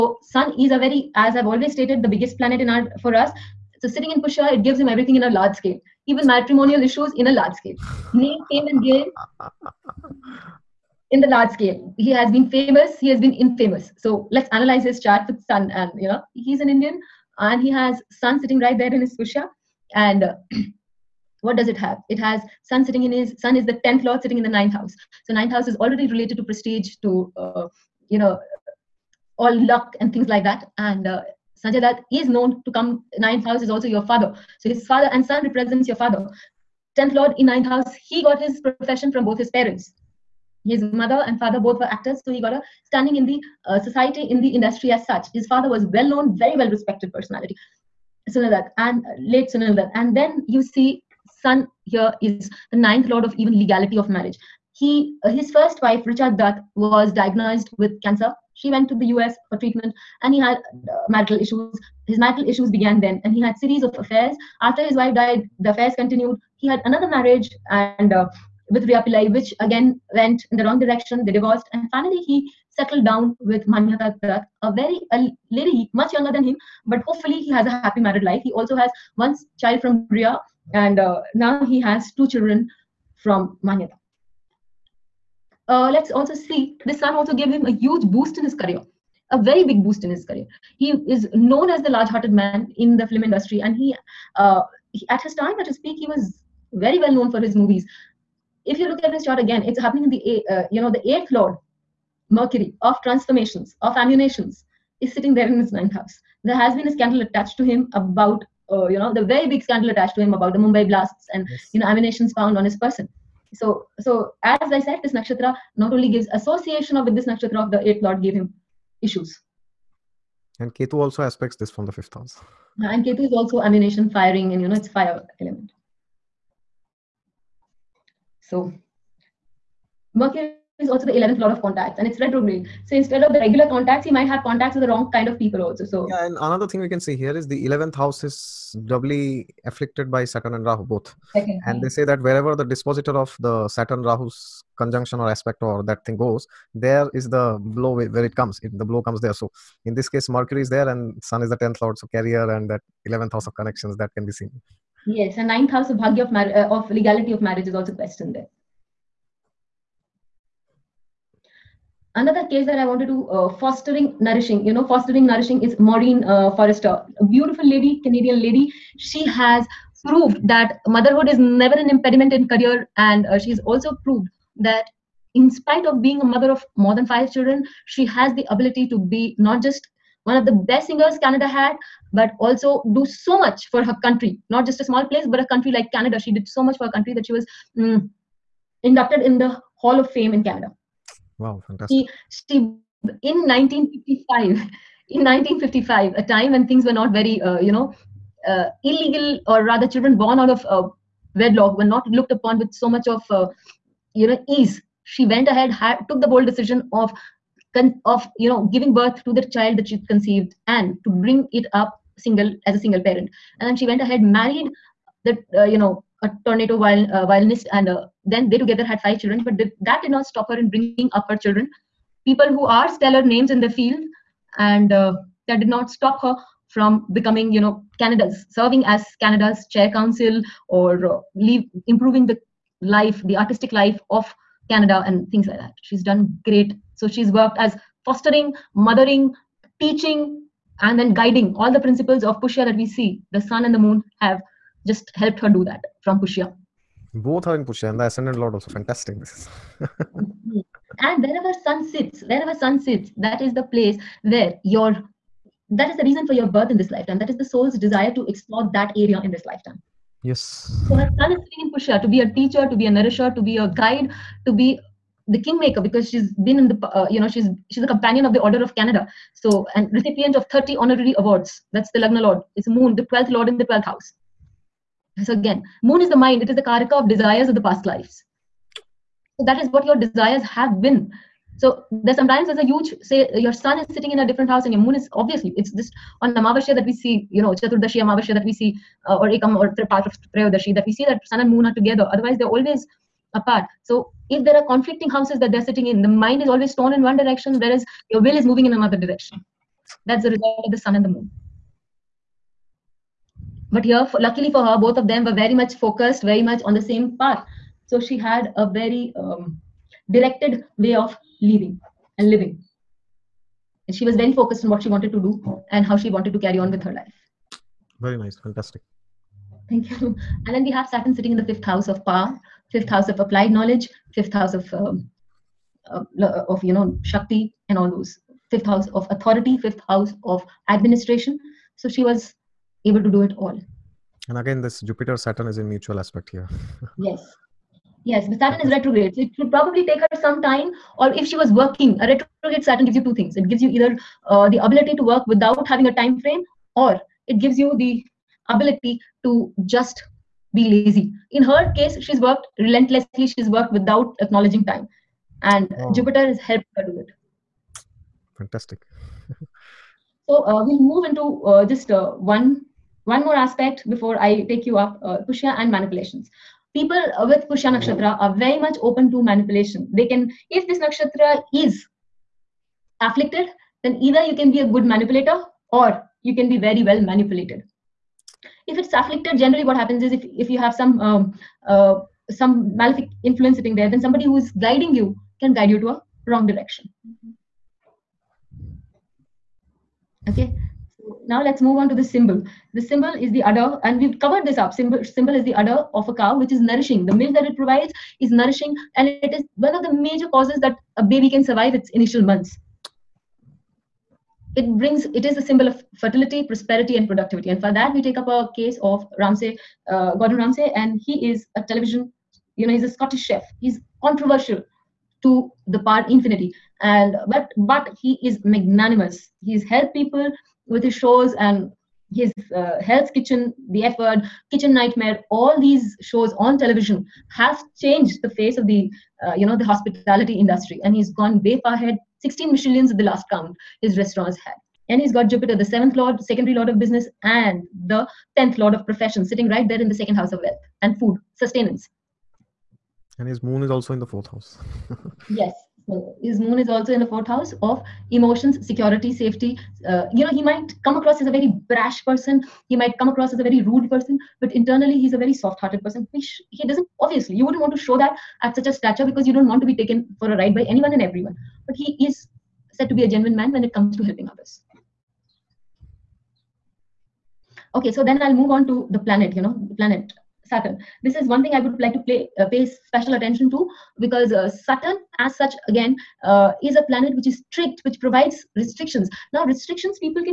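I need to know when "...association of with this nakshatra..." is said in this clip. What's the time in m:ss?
1:56.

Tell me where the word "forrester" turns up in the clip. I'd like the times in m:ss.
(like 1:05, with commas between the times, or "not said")
2:46.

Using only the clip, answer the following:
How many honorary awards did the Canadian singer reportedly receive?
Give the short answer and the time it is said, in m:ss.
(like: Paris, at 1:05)
30, at 4:30.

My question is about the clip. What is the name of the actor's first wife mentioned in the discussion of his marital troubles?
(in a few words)
Richa Dutt.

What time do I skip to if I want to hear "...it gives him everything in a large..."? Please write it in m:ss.
0:04.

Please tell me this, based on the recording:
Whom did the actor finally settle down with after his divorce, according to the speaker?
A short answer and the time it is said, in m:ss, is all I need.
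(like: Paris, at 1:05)
Manyata Dutt, at 1:13.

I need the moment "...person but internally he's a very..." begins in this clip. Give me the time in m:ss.
7:33.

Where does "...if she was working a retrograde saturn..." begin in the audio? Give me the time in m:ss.
5:41.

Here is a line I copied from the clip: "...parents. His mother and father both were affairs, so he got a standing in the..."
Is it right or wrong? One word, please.
wrong.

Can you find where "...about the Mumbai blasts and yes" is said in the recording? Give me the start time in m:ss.
1:50.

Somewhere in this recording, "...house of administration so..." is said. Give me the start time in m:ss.
5:29.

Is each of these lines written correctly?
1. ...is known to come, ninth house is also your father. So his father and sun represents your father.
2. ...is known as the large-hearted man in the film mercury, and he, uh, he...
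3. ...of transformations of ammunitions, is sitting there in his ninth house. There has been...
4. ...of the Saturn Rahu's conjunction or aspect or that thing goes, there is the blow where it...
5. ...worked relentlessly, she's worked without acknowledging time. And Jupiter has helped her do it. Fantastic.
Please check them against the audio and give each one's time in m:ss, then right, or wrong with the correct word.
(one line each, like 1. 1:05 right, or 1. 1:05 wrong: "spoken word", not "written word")
1. 0:32 right
2. 1:30 wrong: "industry", not "mercury"
3. 1:42 right
4. 2:23 right
5. 5:52 right.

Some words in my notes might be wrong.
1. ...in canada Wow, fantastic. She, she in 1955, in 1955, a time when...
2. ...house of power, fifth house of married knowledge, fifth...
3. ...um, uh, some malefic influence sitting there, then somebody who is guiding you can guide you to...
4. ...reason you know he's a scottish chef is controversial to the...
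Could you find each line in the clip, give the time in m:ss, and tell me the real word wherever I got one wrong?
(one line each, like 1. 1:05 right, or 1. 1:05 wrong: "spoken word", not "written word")
1. 3:10 right
2. 5:21 wrong: "applied", not "married"
3. 6:20 right
4. 6:51 wrong: "television", not "reason".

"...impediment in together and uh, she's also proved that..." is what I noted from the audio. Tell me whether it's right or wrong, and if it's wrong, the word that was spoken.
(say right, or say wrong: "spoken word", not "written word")
wrong: "career", not "together".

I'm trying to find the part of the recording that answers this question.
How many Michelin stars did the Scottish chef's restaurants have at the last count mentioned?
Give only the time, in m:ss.
7:12.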